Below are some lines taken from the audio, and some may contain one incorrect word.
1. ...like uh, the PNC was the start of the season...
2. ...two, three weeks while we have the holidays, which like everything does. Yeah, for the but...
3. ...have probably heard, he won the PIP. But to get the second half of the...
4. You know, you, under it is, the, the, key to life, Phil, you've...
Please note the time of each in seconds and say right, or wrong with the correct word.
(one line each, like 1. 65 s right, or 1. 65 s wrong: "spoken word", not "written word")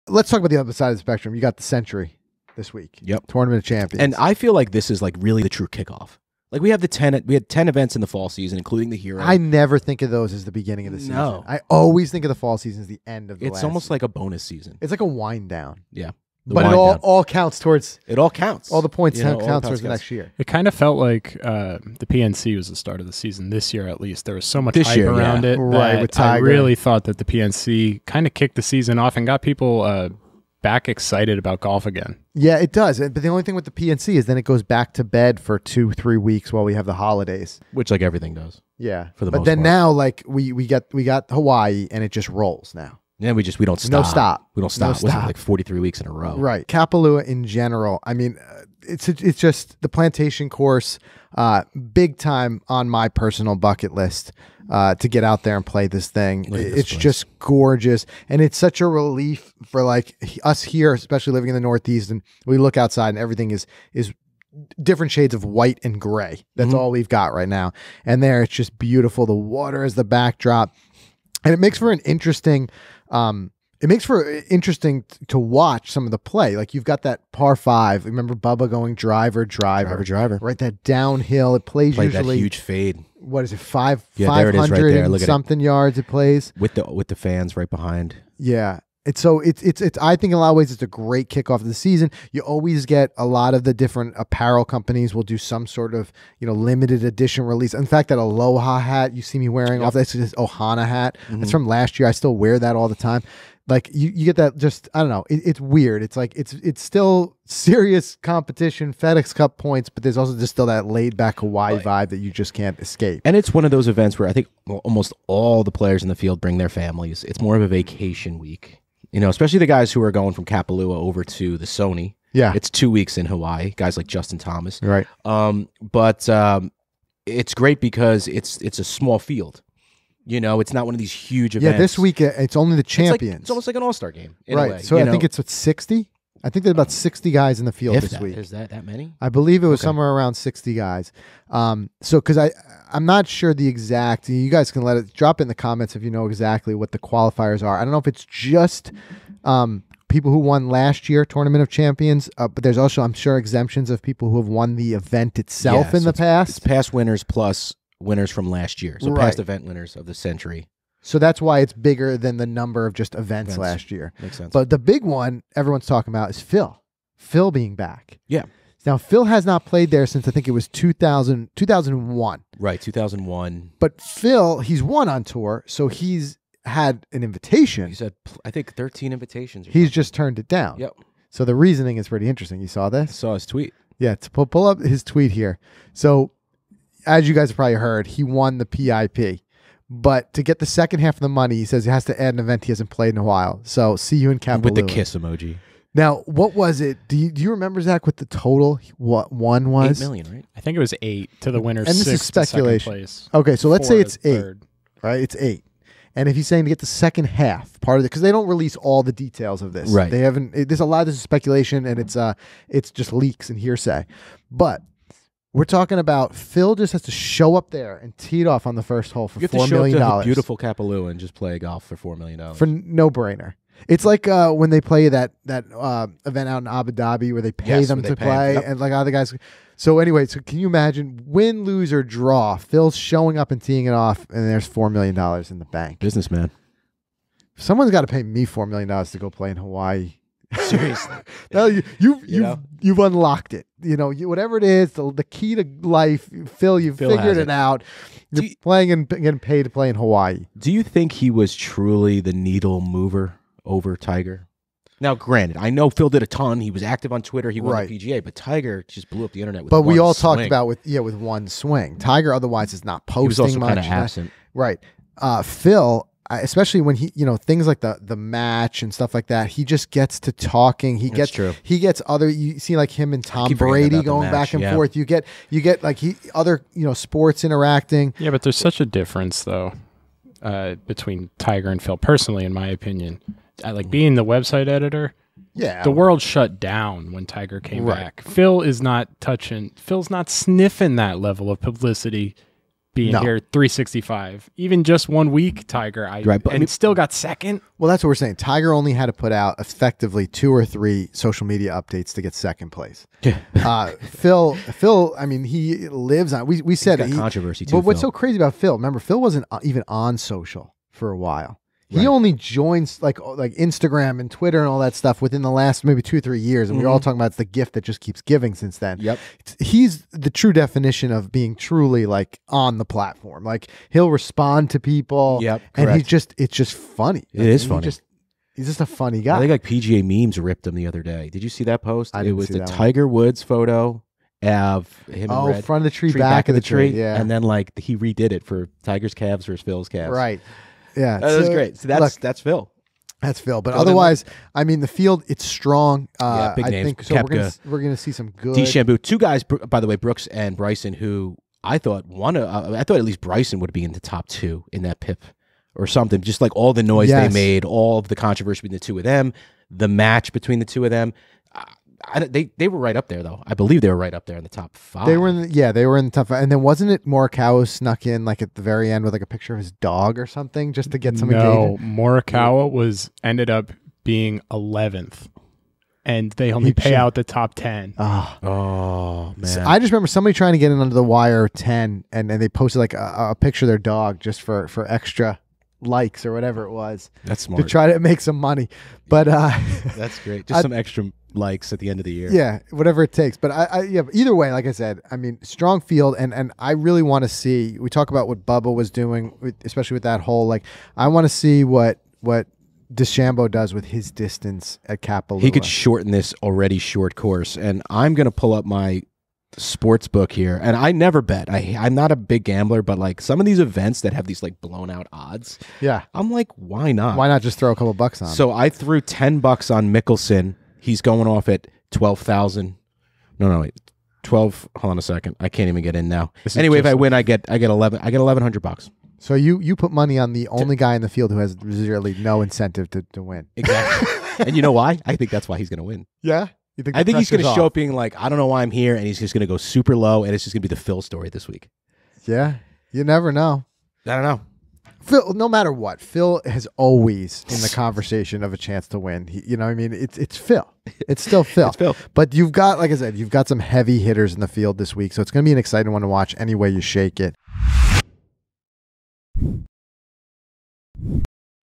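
1. 20 s right
2. 35 s right
3. 187 s right
4. 243 s wrong: "whatever", not "under".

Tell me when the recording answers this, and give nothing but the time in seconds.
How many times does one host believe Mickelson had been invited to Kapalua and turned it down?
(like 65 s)
178 s.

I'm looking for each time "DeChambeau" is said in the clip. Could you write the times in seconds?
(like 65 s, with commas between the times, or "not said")
348 s, 402 s.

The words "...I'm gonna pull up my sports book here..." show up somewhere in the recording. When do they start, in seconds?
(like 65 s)
407 s.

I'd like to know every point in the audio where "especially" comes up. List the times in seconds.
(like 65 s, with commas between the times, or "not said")
60 s, 119 s, 266 s, 399 s.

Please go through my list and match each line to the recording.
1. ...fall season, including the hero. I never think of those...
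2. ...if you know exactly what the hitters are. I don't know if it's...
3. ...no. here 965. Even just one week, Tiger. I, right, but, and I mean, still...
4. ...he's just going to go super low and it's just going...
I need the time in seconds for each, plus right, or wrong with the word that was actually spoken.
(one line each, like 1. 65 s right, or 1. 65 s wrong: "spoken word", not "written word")
1. 8 s right
2. 145 s wrong: "qualifiers", not "hitters"
3. 293 s wrong: "365", not "965"
4. 439 s right.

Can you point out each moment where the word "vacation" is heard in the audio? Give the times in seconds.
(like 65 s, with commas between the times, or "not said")
117 s.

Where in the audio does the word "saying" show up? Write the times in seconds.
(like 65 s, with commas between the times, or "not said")
206 s, 298 s.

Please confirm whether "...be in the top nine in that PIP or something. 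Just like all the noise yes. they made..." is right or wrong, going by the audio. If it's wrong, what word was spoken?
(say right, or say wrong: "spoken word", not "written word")
wrong: "two", not "nine".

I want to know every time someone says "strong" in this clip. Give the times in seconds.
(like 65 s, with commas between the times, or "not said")
345 s, 395 s.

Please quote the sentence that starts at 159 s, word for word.
past event winners of the Sentry so that's why it's bigger than the number of just events, events.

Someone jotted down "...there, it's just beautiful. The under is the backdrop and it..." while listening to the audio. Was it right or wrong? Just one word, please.
wrong.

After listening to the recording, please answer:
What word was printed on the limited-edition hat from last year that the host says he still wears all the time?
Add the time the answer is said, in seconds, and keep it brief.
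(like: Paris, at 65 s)
Ohana, at 100 s.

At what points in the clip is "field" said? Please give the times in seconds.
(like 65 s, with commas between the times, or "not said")
116 s, 129 s, 137 s, 344 s, 395 s, 431 s, 454 s.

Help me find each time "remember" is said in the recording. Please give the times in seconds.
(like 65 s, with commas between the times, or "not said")
78 s, 197 s, 308 s, 379 s.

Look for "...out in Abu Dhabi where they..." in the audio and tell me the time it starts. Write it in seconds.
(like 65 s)
226 s.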